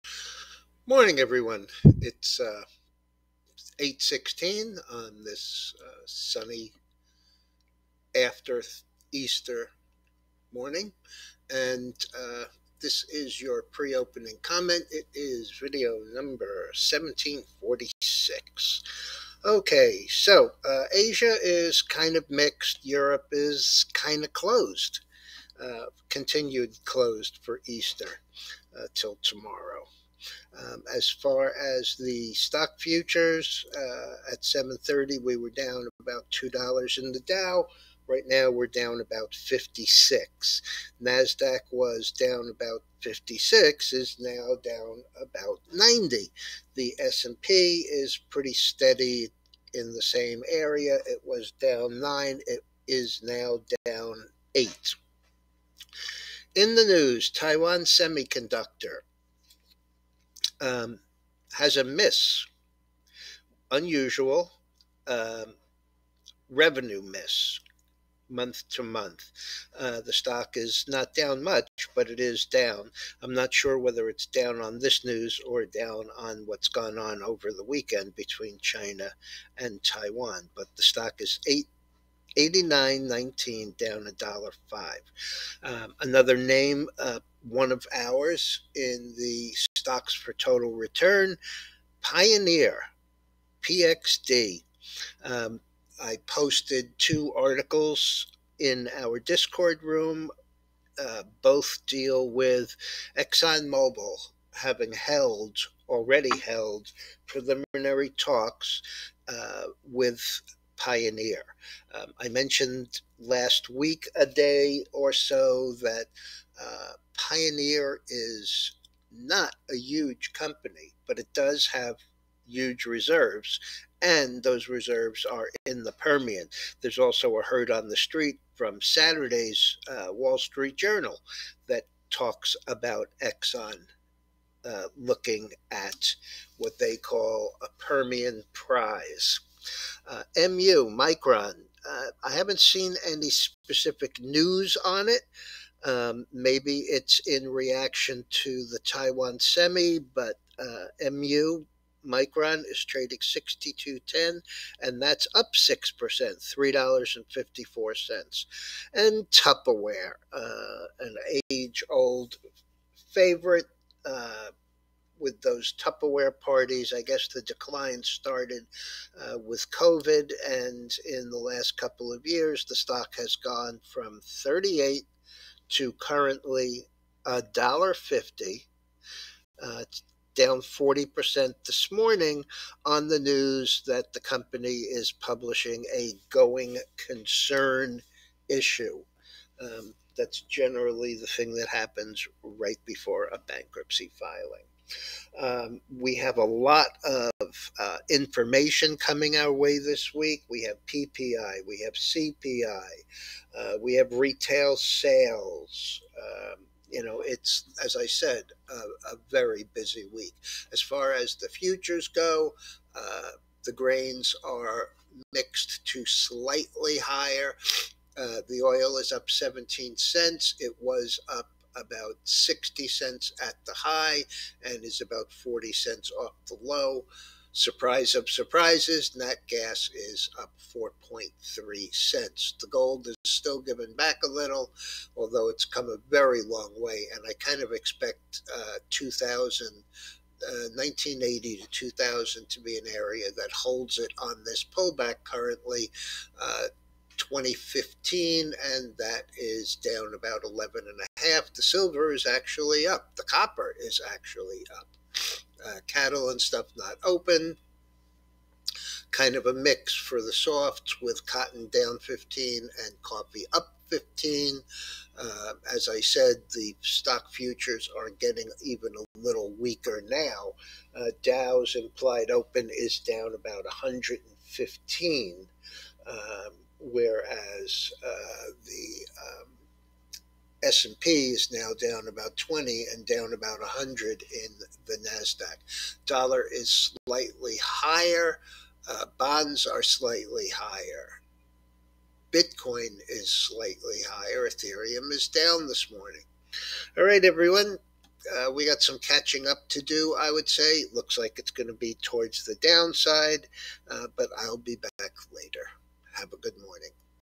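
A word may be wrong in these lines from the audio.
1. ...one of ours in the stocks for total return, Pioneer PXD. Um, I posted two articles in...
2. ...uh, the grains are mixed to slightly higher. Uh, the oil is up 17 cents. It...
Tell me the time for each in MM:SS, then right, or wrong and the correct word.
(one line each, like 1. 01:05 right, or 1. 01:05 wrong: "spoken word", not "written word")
1. 01:27 right
2. 03:32 right.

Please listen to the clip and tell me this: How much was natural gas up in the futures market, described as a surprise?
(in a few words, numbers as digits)
4.3 cents.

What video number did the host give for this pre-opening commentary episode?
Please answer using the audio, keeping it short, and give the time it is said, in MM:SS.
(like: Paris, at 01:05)
1746, at 00:16.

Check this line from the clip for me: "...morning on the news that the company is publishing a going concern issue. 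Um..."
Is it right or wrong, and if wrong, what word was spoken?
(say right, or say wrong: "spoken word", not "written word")
right.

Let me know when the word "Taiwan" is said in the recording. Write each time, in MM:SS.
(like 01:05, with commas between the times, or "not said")
00:57, 01:19, 02:28.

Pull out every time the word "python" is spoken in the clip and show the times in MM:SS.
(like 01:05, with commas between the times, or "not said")
not said.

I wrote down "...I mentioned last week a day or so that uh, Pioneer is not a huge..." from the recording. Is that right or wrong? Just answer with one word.
right.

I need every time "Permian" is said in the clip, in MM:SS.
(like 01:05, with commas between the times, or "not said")
02:05, 02:17.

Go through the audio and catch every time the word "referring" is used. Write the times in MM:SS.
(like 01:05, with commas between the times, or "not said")
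not said.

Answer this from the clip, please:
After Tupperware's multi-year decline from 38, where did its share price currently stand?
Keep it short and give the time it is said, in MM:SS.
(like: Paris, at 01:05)
$1.50, at 02:57.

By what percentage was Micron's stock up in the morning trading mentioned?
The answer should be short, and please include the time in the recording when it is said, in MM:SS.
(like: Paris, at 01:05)
6%, at 02:35.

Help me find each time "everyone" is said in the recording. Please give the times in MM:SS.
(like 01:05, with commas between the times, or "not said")
00:01, 04:57.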